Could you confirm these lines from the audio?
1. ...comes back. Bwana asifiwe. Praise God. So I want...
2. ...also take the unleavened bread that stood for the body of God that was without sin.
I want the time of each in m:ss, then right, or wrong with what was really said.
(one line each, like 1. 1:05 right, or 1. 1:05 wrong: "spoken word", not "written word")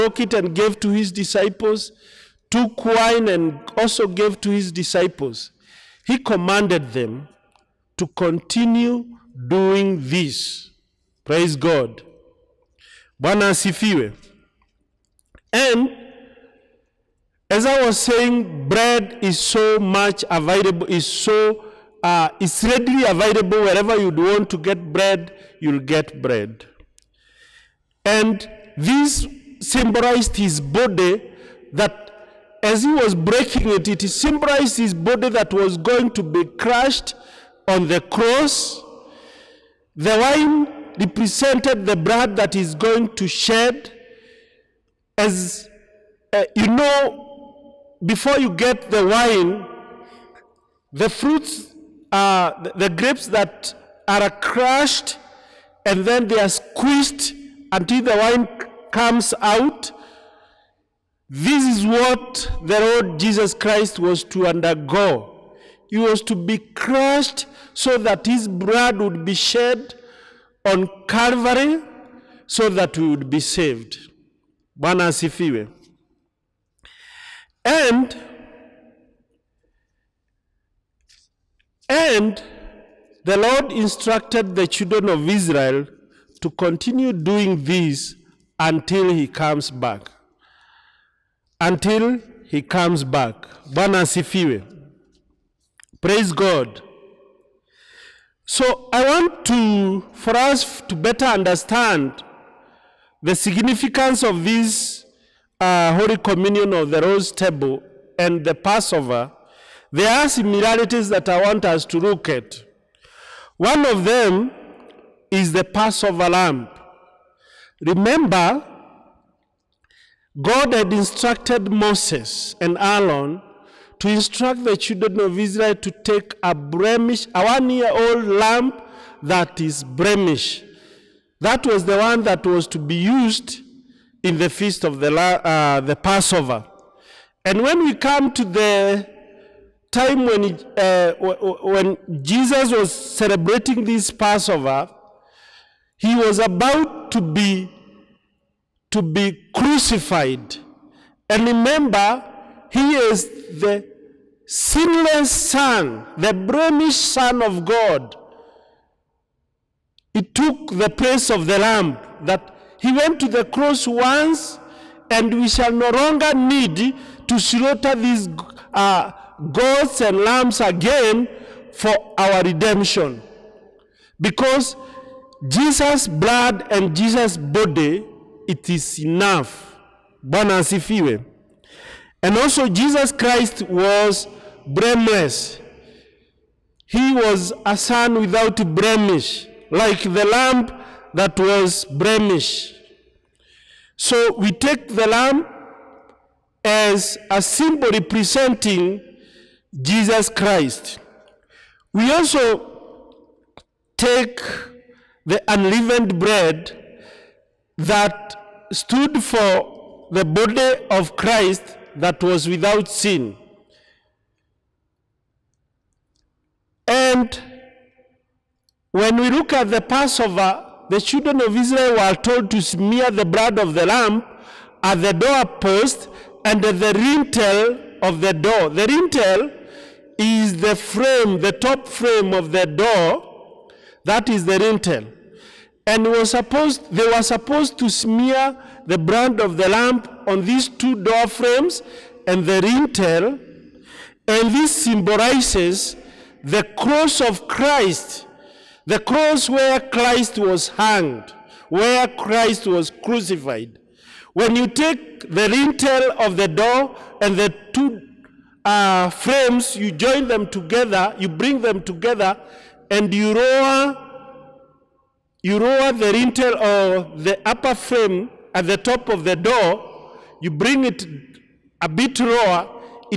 1. 1:32 right
2. 3:22 wrong: "Christ", not "God".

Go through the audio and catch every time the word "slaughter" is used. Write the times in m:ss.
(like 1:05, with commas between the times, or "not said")
2:47.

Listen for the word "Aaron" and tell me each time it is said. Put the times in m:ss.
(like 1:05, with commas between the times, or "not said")
2:02.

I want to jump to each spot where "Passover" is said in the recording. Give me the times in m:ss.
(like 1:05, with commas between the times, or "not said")
1:48, 1:55, 2:15, 2:24, 3:39.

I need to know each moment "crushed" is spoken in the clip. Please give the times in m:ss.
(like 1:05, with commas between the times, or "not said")
0:36, 0:54, 1:06.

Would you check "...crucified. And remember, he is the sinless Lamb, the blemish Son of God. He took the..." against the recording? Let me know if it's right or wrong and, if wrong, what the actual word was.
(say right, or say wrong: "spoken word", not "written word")
wrong: "Son", not "Lamb".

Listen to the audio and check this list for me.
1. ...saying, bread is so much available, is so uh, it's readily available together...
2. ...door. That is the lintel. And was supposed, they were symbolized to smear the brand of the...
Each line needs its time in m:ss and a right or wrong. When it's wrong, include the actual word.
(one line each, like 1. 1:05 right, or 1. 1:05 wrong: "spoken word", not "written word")
1. 0:17 wrong: "wherever", not "together"
2. 3:52 wrong: "supposed", not "symbolized".